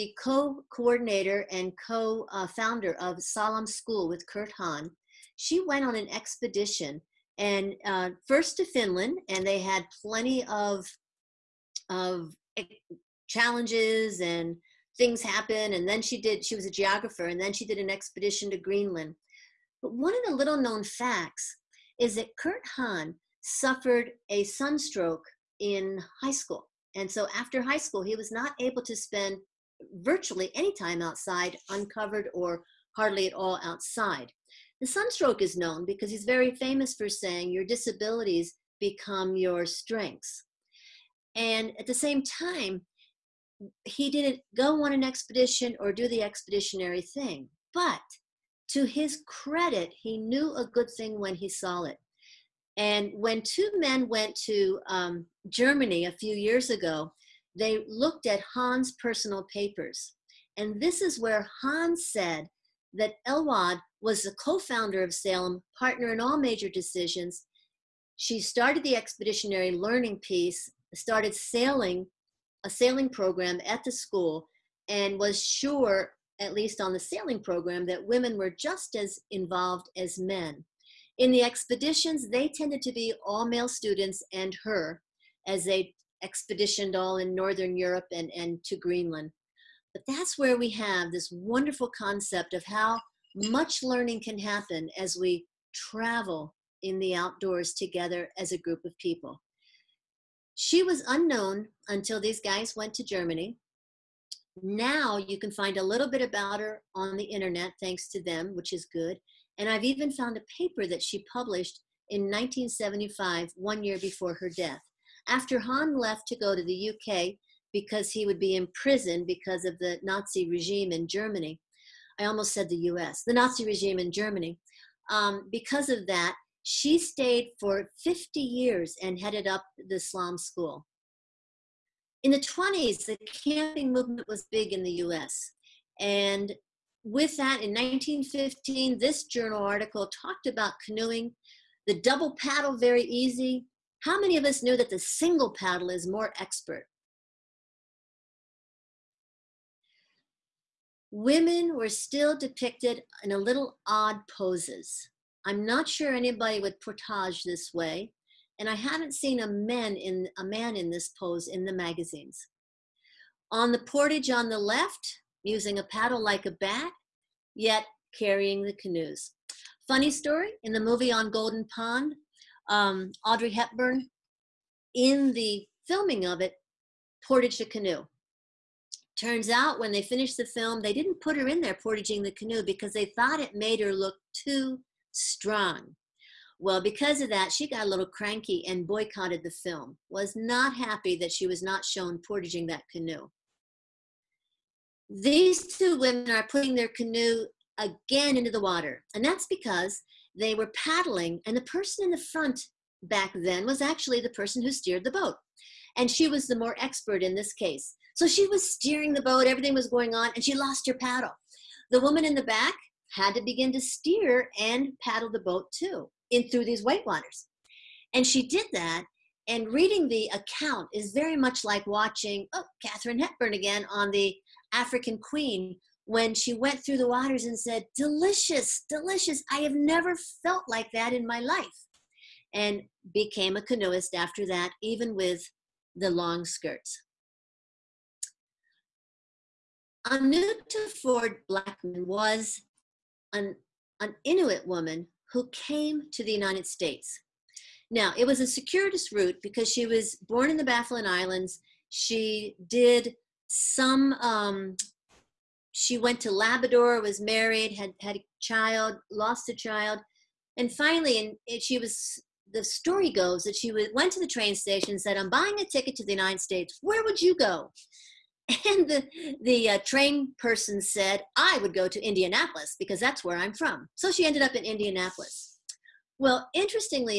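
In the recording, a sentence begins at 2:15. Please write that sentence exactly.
And with that, in 1915, this journal article talked about canoeing, the double paddle, very easy.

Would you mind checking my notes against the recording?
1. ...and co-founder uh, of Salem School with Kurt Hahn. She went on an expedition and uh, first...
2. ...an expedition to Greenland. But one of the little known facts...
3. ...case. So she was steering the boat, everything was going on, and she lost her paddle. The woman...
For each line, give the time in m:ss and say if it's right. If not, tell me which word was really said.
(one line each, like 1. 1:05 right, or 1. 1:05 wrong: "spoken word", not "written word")
1. 0:01 right
2. 0:17 right
3. 3:27 right.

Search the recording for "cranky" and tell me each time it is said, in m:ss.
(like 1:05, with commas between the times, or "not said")
3:08.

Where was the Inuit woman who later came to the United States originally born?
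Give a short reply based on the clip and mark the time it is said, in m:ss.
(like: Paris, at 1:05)
Baffin Islands, at 4:10.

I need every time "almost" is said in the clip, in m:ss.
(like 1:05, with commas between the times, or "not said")
2:02.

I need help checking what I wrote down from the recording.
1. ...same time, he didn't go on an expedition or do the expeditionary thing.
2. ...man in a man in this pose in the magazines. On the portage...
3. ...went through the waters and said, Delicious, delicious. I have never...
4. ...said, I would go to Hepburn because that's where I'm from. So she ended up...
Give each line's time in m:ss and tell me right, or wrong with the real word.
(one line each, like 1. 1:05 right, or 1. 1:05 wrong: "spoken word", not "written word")
1. 0:41 right
2. 2:39 right
3. 3:46 right
4. 4:30 wrong: "Indianapolis", not "Hepburn".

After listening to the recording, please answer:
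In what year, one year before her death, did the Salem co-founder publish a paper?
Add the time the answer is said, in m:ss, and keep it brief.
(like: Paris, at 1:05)
1975, at 1:52.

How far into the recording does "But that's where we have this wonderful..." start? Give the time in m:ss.
1:29.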